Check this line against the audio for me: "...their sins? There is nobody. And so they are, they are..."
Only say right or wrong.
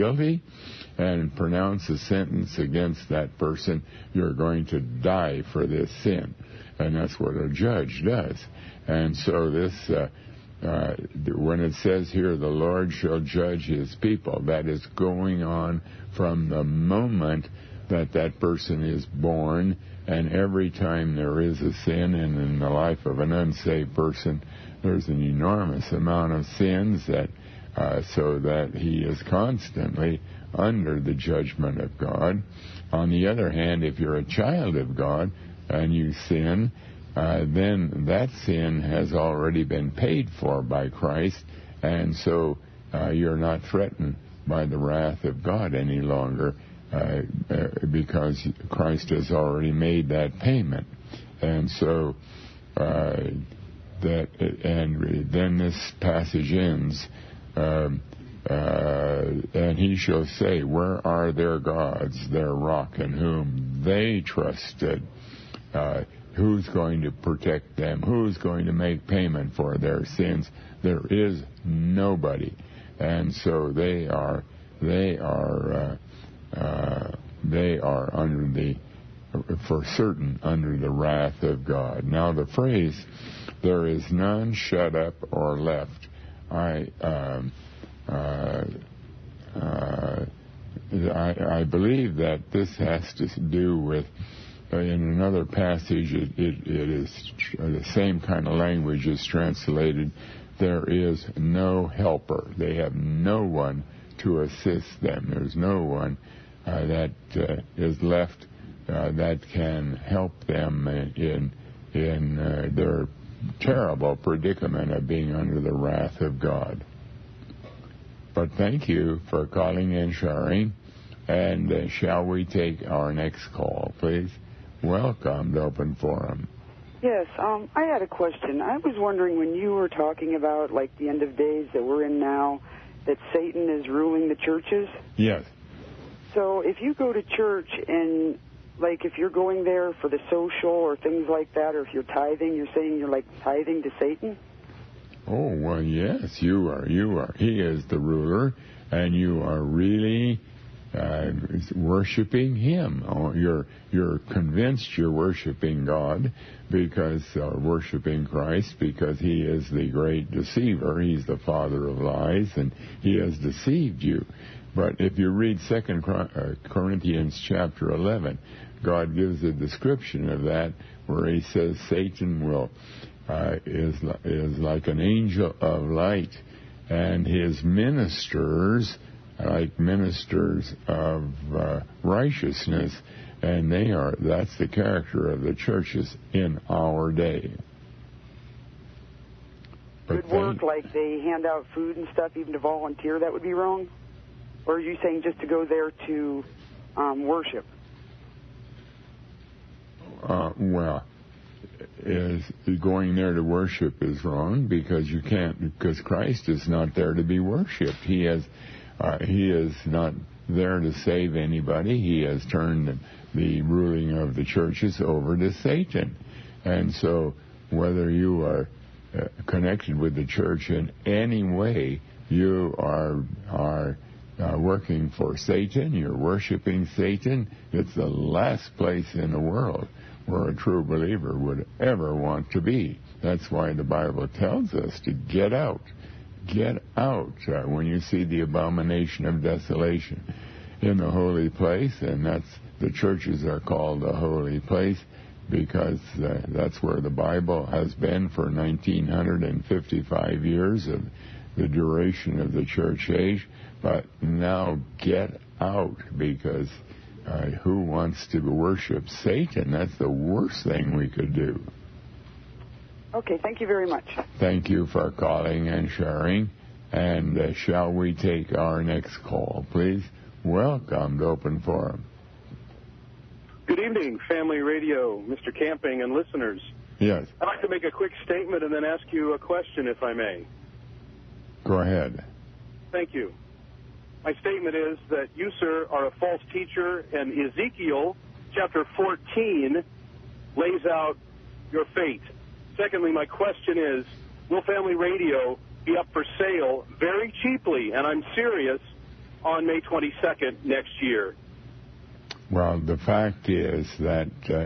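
right.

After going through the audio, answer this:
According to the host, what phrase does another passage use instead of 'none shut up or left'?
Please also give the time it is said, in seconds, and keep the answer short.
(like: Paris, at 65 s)
There is no helper, at 100 s.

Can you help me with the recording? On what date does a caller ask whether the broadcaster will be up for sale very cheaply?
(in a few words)
May 22.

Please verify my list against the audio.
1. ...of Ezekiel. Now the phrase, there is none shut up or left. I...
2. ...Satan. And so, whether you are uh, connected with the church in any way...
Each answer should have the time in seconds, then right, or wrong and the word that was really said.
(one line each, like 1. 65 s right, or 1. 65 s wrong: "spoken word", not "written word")
1. 81 s wrong: "God", not "Ezekiel"
2. 215 s right.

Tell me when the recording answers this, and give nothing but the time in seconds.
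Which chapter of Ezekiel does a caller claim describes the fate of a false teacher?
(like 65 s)
287 s.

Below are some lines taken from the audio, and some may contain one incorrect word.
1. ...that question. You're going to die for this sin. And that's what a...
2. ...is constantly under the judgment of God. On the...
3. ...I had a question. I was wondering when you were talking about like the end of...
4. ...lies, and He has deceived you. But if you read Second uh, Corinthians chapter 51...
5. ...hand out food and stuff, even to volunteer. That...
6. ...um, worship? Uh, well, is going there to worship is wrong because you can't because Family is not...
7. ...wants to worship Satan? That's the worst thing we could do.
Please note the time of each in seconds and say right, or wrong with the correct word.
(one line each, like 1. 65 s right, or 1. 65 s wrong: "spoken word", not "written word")
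1. 3 s wrong: "person", not "question"
2. 29 s right
3. 127 s right
4. 161 s wrong: "11", not "51"
5. 191 s right
6. 196 s wrong: "Christ", not "Family"
7. 257 s right.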